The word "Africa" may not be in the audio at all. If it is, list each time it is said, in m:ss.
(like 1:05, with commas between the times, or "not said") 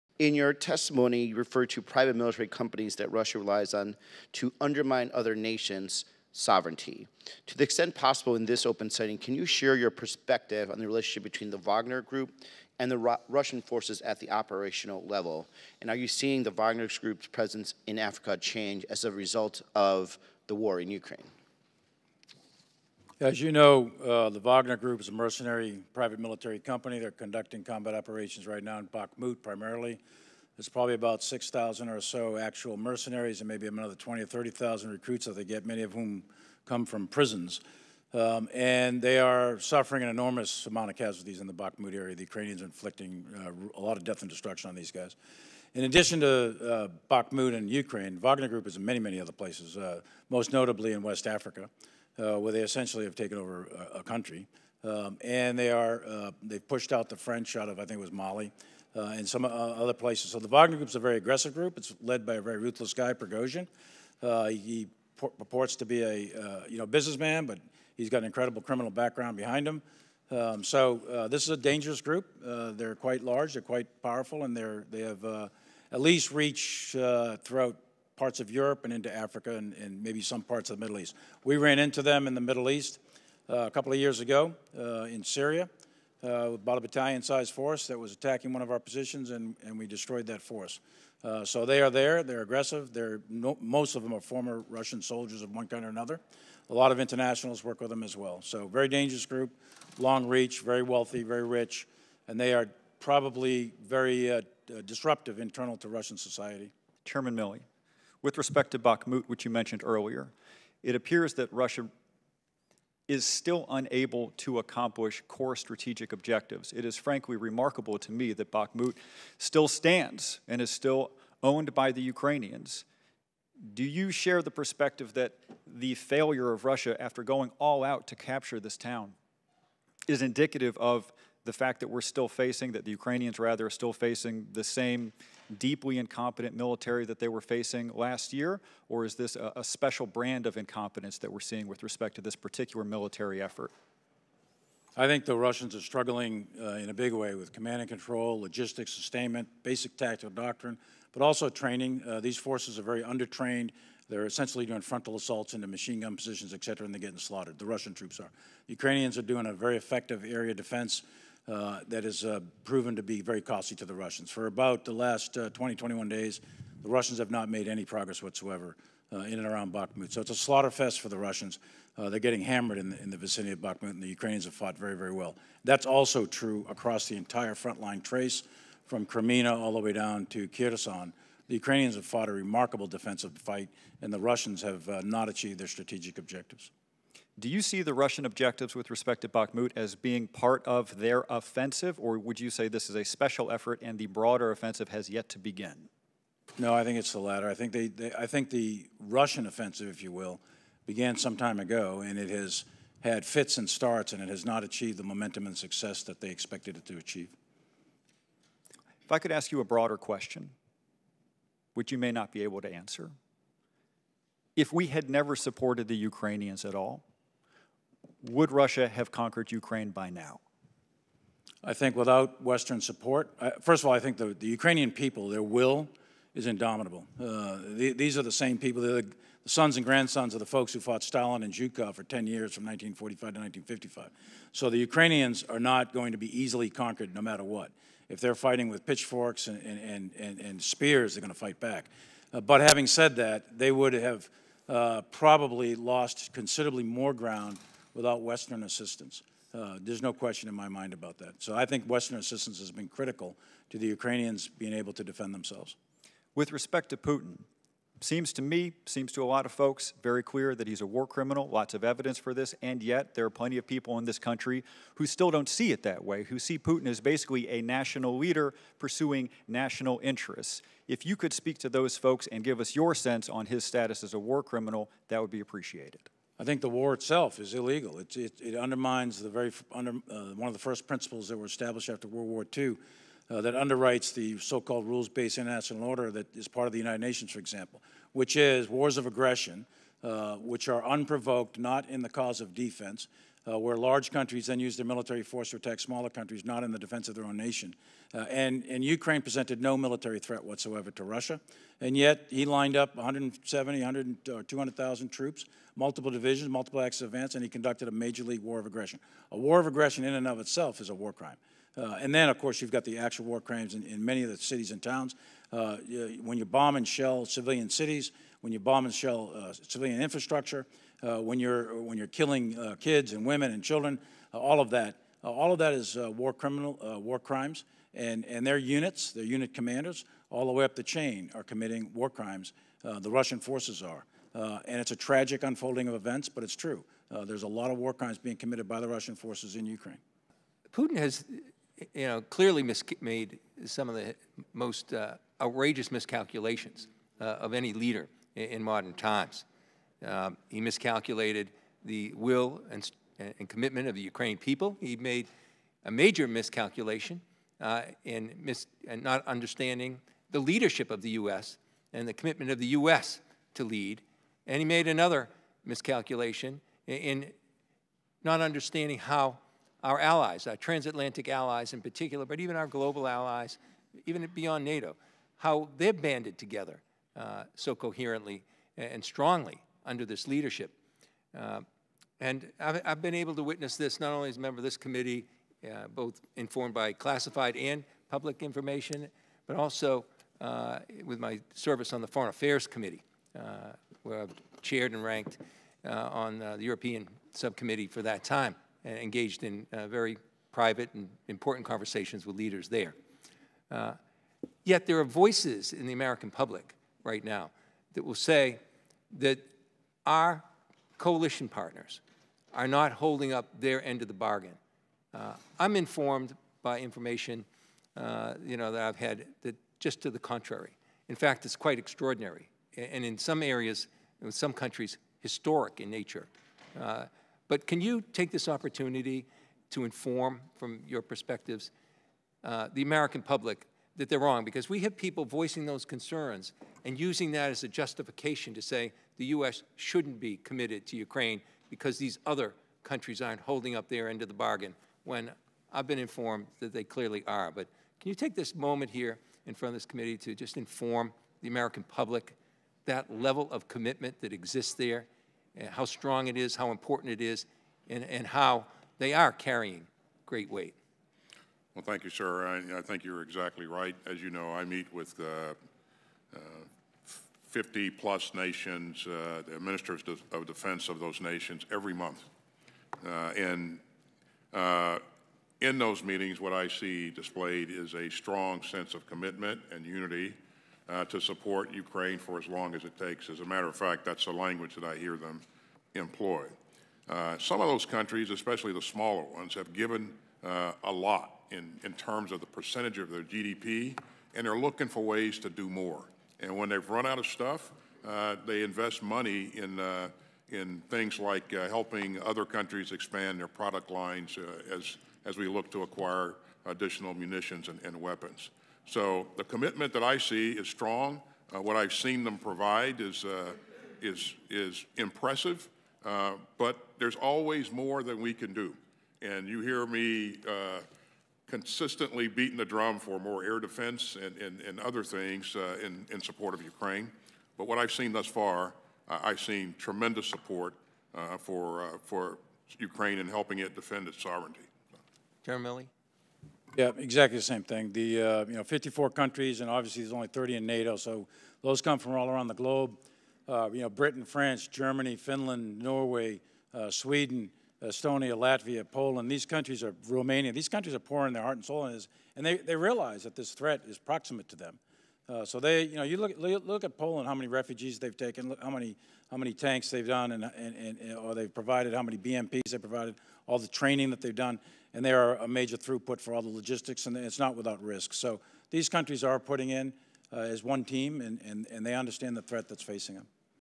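0:17, 0:51, 1:19.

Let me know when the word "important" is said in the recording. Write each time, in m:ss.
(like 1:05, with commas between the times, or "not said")
6:41, 7:36.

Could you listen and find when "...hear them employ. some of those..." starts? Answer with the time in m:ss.
8:04.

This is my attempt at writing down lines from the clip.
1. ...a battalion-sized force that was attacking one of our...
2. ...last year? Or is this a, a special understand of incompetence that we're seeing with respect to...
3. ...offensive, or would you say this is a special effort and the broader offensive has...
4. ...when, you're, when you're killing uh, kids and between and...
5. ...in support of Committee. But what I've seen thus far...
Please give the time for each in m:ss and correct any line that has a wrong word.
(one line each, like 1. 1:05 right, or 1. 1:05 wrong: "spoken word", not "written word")
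1. 1:26 right
2. 2:17 wrong: "brand", not "understand"
3. 3:11 right
4. 5:21 wrong: "women", not "between"
5. 8:46 wrong: "Ukraine", not "Committee".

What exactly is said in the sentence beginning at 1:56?
It is frankly remarkable to me that Bakhmut still stands and is still owned by the Ukrainians.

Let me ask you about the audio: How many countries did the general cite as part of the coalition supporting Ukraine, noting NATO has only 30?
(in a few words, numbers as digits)
54.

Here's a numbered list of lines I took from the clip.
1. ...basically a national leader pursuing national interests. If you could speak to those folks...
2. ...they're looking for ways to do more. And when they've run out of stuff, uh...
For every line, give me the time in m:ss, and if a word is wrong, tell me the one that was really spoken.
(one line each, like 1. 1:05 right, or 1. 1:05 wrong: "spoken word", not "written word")
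1. 4:27 right
2. 8:14 right.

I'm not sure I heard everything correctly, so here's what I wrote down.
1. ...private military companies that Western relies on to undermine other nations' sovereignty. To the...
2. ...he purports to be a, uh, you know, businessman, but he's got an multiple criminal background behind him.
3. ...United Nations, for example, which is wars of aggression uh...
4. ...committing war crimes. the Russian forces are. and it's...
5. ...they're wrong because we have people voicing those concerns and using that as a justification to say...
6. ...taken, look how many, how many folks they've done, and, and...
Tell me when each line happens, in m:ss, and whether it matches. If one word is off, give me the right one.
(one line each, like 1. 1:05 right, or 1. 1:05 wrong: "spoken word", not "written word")
1. 0:01 wrong: "Russia", not "Western"
2. 1:04 wrong: "incredible", not "multiple"
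3. 4:46 right
4. 5:31 right
5. 7:14 right
6. 9:18 wrong: "tanks", not "folks".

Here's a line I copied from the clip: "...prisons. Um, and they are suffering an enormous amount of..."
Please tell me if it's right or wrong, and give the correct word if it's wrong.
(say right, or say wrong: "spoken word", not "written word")
right.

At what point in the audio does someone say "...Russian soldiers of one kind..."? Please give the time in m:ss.
1:34.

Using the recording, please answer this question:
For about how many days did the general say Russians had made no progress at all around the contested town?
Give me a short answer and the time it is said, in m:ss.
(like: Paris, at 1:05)
21, at 2:45.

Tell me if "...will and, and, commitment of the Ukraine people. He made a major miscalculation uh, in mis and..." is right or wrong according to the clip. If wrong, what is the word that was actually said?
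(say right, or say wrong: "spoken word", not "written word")
right.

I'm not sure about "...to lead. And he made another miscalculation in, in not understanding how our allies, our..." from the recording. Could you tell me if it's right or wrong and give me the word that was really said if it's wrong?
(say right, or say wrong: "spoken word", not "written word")
right.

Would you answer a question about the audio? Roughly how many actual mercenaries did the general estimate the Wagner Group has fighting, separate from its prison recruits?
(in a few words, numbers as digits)
6,000.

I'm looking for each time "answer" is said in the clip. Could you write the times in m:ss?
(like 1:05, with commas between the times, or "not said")
3:32.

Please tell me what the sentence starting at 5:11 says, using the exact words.
Uh, and then, of course, you've got the actual war crimes in, in many of the cities and towns.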